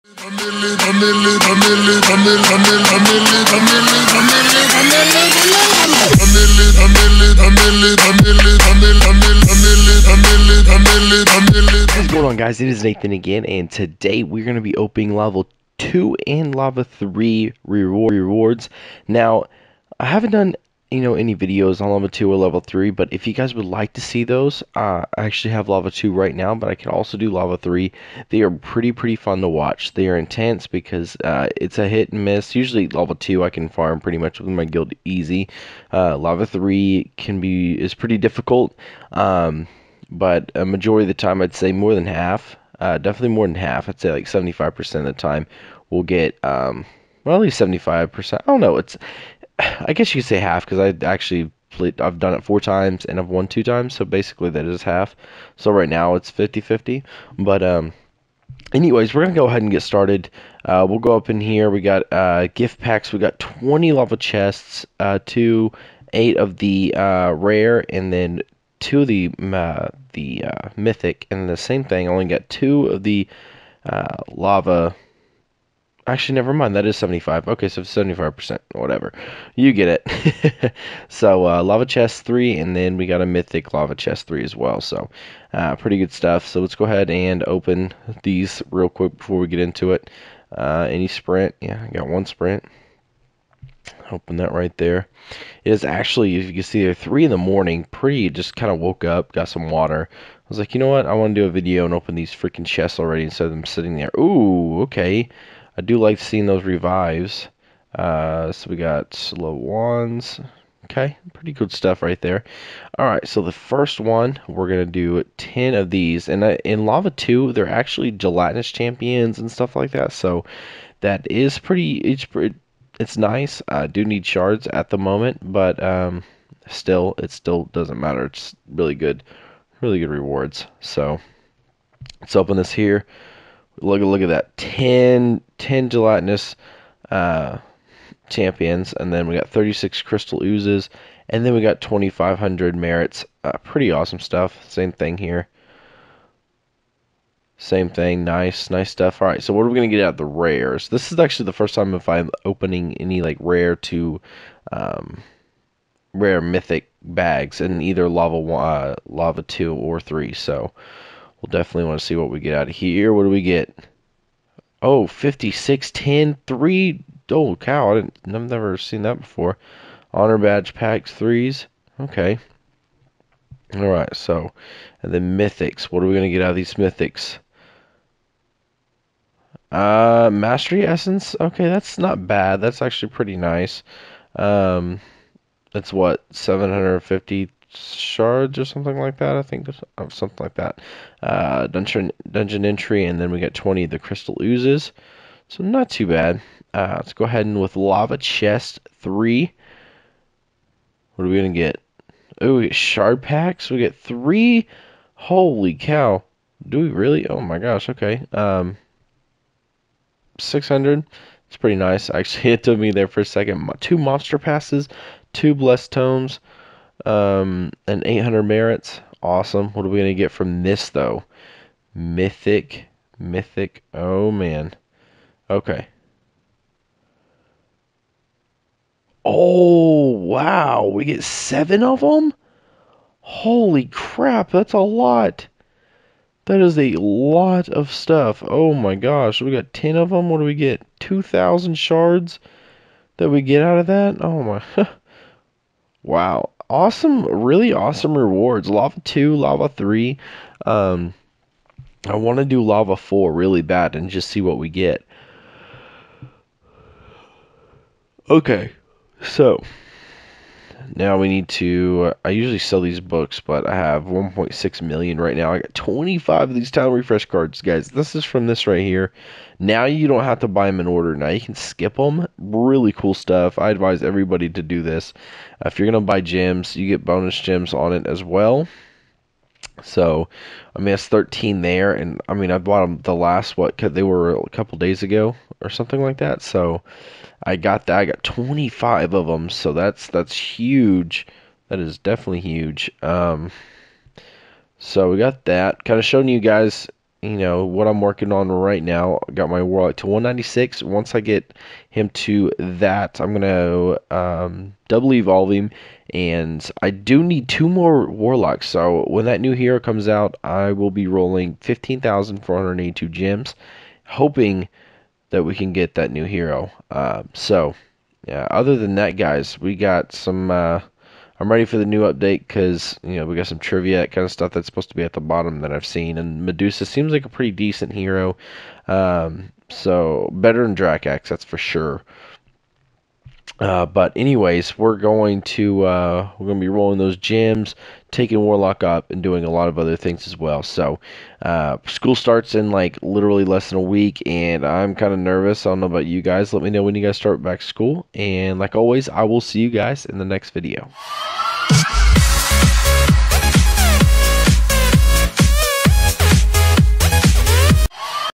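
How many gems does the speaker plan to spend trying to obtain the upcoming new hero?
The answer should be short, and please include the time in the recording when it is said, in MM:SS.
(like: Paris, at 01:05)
15,482, at 05:11.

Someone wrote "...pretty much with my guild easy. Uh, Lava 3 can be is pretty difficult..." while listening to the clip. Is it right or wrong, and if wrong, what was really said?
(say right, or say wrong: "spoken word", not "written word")
right.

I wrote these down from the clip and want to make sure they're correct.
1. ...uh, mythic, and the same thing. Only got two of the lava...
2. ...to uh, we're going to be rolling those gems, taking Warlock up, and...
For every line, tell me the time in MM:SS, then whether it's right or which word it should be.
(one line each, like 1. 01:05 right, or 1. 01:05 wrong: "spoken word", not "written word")
1. 01:10 right
2. 05:35 right.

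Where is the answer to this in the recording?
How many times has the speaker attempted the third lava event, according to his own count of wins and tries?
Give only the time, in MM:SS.
00:52.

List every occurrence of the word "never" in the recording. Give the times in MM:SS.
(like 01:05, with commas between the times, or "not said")
01:16, 02:48.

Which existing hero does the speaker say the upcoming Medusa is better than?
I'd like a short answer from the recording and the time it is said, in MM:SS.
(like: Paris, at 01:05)
Drakax, at 05:30.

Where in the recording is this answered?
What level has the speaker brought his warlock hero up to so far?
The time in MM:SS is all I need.
05:00.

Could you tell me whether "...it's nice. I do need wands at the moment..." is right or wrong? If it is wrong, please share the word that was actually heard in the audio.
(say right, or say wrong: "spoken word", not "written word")
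wrong: "shards", not "wands".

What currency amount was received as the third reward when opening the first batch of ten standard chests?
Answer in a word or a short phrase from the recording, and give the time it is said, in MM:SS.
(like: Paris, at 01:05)
2500 merits, at 02:21.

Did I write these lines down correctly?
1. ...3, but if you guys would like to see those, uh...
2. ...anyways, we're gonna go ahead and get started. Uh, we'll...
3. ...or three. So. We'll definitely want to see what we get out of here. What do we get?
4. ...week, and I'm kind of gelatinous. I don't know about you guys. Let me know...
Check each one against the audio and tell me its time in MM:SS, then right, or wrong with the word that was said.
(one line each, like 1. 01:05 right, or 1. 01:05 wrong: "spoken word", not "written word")
1. 00:22 right
2. 00:58 right
3. 02:39 right
4. 05:43 wrong: "nervous", not "gelatinous".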